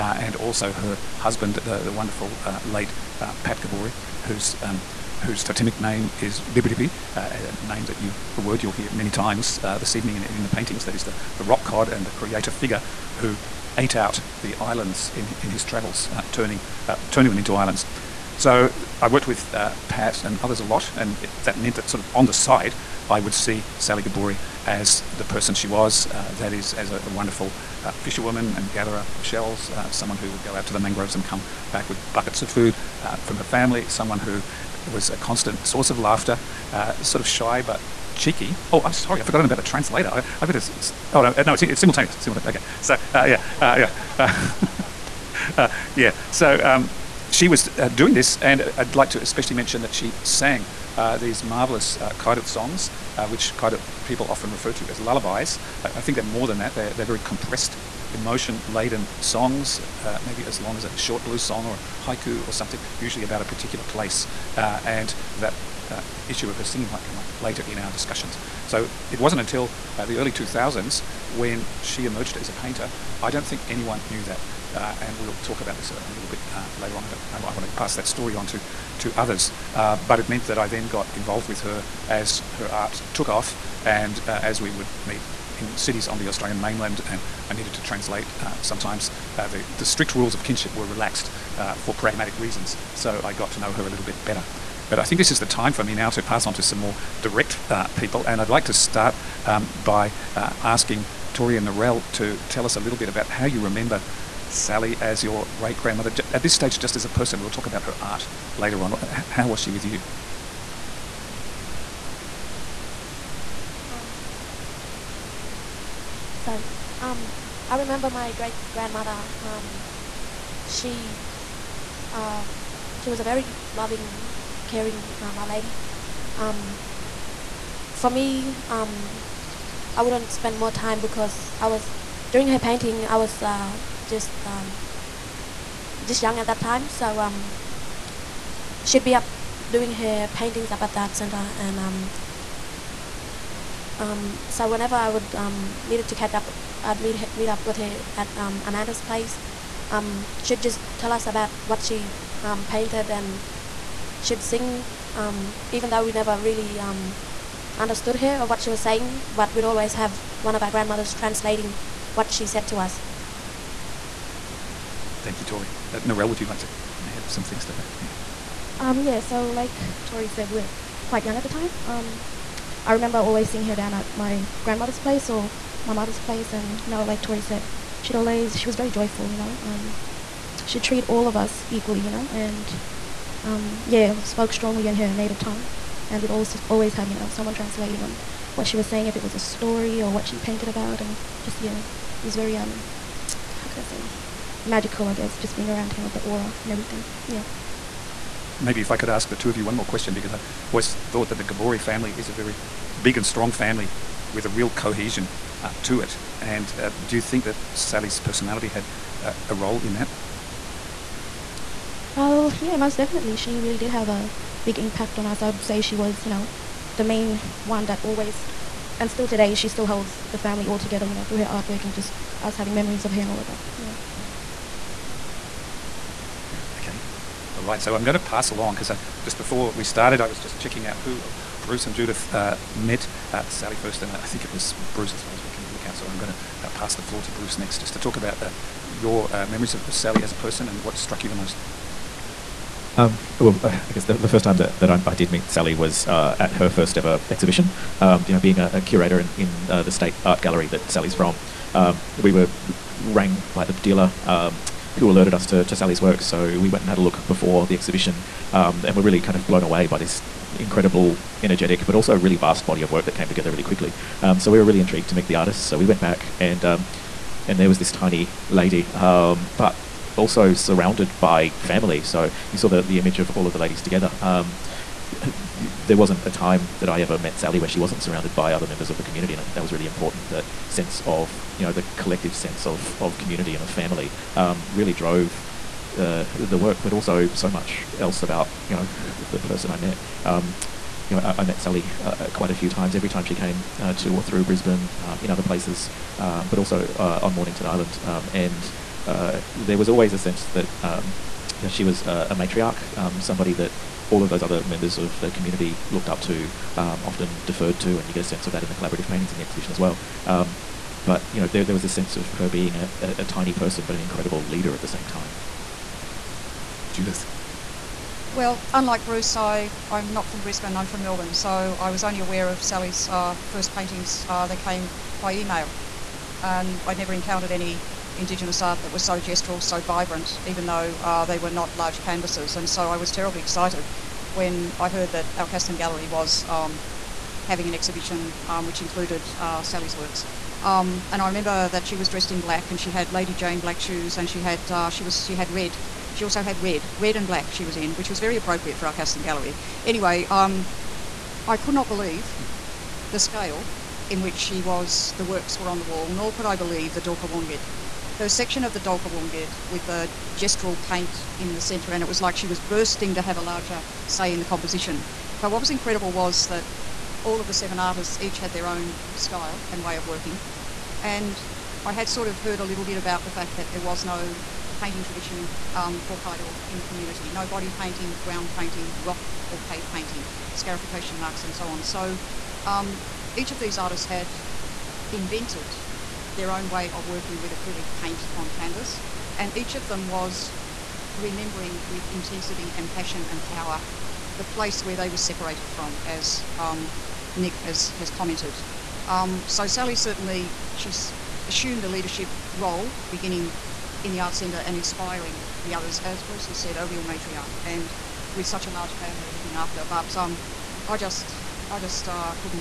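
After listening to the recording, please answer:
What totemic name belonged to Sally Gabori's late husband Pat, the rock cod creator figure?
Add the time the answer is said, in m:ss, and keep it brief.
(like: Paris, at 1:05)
Dibirdibi, at 0:06.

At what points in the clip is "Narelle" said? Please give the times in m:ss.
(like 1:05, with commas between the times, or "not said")
1:41, 2:45.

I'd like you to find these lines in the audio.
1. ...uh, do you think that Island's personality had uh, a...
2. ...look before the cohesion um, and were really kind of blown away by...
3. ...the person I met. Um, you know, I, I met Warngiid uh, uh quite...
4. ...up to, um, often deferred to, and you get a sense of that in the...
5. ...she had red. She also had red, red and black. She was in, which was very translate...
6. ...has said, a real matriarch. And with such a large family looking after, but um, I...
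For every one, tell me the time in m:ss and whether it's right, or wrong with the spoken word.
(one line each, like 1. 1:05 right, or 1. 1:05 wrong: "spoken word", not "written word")
1. 3:26 wrong: "Sally", not "Island"
2. 4:16 wrong: "exhibition", not "cohesion"
3. 4:49 wrong: "Sally", not "Warngiid"
4. 5:06 right
5. 5:45 wrong: "appropriate", not "translate"
6. 6:46 right.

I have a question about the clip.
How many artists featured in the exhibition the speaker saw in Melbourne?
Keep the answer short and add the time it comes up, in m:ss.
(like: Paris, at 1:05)
7, at 6:07.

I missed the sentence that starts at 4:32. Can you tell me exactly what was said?
So you saw the the image of all of the ladies together.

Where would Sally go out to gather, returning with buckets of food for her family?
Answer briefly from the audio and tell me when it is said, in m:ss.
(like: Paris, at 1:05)
the mangroves, at 0:30.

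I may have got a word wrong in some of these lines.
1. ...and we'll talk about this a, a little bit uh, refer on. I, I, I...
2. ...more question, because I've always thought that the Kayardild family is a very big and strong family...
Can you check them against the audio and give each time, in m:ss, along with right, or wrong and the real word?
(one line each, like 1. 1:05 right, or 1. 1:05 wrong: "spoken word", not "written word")
1. 1:14 wrong: "later", not "refer"
2. 3:19 wrong: "Gabori", not "Kayardild".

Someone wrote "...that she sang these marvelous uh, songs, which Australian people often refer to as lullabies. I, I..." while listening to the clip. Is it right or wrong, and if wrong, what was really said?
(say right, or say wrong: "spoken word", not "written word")
wrong: "Kayardild", not "Australian".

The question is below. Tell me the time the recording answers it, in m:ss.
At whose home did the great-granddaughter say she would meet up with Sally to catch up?
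2:28.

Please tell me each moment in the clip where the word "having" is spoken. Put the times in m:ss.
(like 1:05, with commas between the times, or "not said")
3:42, 5:37.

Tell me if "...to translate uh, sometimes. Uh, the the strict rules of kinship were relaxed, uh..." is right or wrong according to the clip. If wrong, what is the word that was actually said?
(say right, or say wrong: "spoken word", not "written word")
right.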